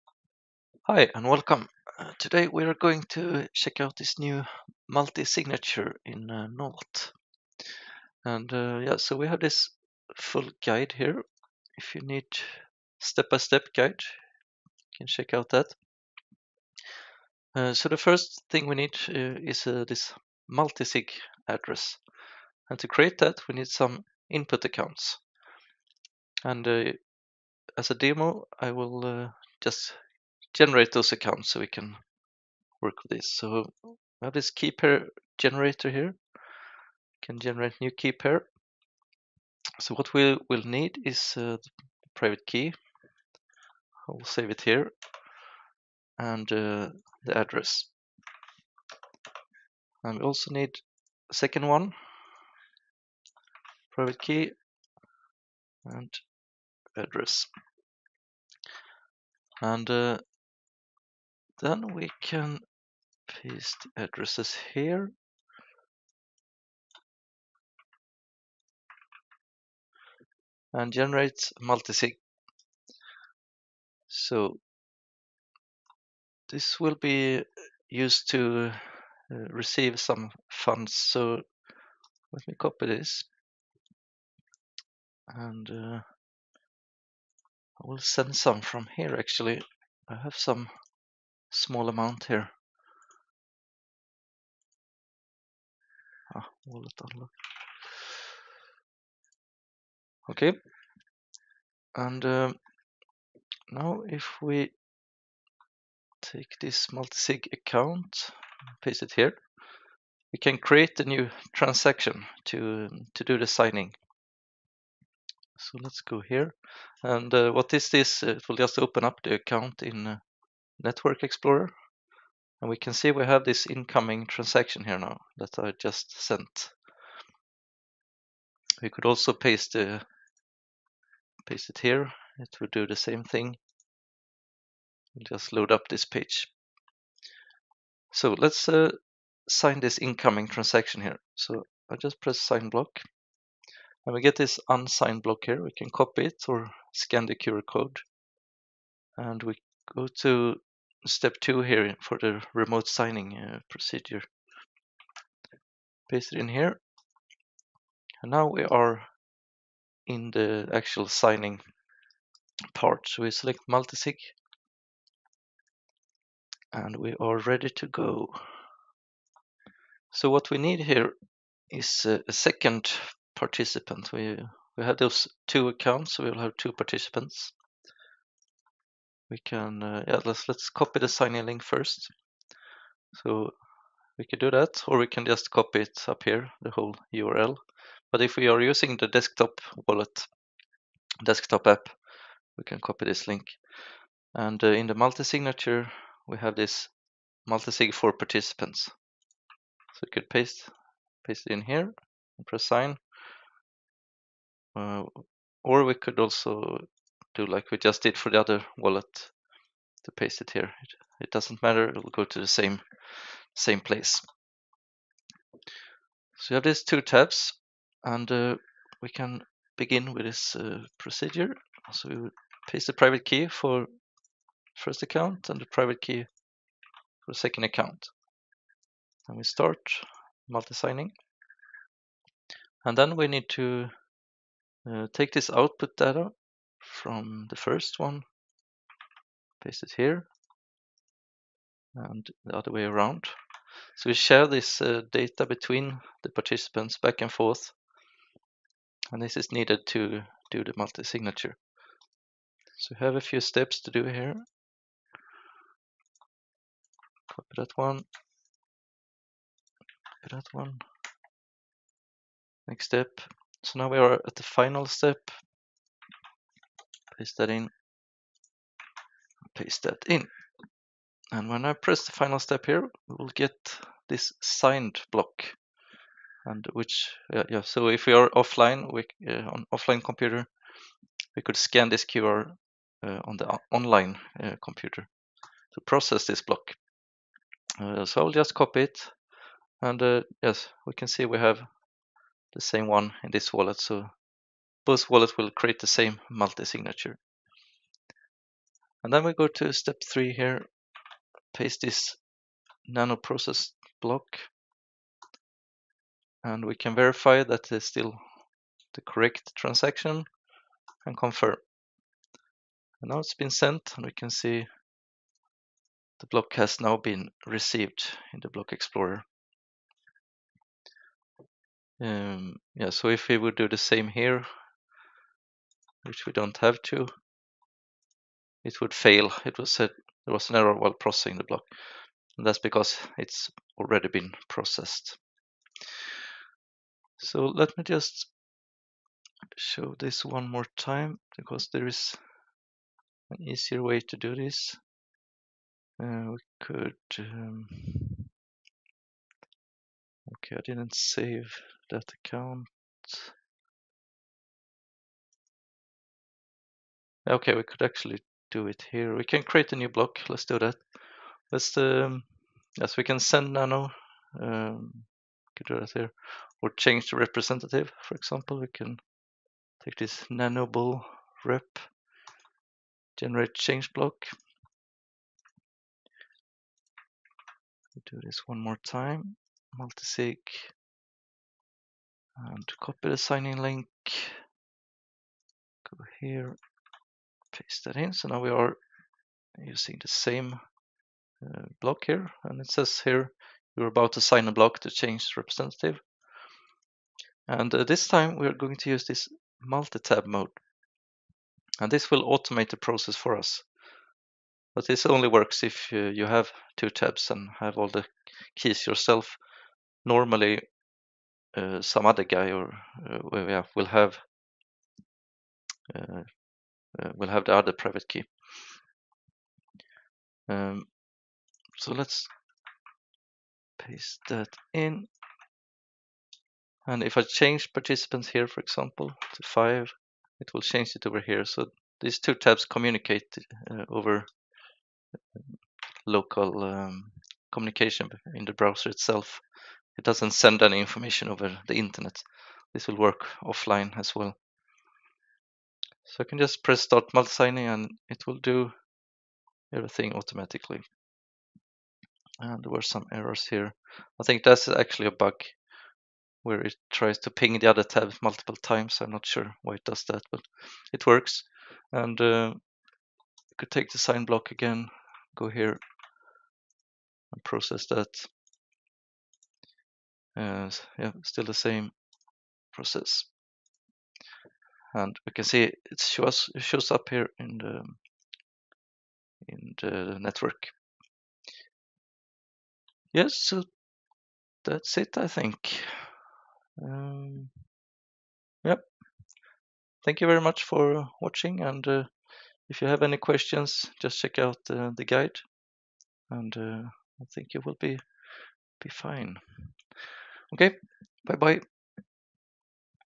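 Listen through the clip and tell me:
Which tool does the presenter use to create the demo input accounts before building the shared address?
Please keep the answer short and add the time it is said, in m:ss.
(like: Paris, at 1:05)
key pair generator, at 0:34.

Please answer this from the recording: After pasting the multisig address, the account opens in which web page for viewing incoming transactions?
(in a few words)
Network Explorer.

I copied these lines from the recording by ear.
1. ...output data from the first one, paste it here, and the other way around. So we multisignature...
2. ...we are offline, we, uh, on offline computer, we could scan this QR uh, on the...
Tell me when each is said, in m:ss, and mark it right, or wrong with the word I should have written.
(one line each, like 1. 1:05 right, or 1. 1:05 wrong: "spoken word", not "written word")
1. 3:55 wrong: "share", not "multisignature"
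2. 4:38 right.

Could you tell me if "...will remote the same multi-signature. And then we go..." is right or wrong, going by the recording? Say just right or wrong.
wrong.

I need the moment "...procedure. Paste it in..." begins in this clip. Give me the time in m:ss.
2:33.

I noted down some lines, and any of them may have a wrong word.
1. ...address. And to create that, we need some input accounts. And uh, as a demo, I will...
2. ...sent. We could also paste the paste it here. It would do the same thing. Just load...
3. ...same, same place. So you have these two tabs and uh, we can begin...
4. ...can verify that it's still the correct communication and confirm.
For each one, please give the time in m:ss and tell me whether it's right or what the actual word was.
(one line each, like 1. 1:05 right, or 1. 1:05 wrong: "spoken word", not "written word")
1. 0:21 right
2. 2:06 right
3. 3:32 right
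4. 5:06 wrong: "transaction", not "communication".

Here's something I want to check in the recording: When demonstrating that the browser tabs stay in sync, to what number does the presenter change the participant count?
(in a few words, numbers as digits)
5.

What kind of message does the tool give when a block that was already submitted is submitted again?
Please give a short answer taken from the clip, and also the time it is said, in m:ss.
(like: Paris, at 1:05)
an error, at 5:30.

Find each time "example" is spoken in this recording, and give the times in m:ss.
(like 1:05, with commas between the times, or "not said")
6:08, 7:08.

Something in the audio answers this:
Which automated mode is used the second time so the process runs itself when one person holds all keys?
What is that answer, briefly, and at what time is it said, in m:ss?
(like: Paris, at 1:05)
multi-tab mode, at 6:39.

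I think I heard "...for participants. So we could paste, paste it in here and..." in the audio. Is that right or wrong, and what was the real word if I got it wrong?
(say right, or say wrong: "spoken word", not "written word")
right.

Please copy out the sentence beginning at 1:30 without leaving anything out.
I have some small amount here.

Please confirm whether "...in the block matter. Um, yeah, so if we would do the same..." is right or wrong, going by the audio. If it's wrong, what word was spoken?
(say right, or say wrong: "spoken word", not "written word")
wrong: "explorer", not "matter".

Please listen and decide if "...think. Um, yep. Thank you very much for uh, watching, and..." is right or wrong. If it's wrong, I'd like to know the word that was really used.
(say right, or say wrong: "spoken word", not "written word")
right.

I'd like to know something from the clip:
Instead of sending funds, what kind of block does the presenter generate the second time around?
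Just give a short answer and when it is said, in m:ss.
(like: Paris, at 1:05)
change block, at 6:13.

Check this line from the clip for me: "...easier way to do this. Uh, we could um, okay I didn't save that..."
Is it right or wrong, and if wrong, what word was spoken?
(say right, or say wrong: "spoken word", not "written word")
right.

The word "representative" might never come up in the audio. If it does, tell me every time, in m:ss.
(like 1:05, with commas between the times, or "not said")
6:07, 6:35.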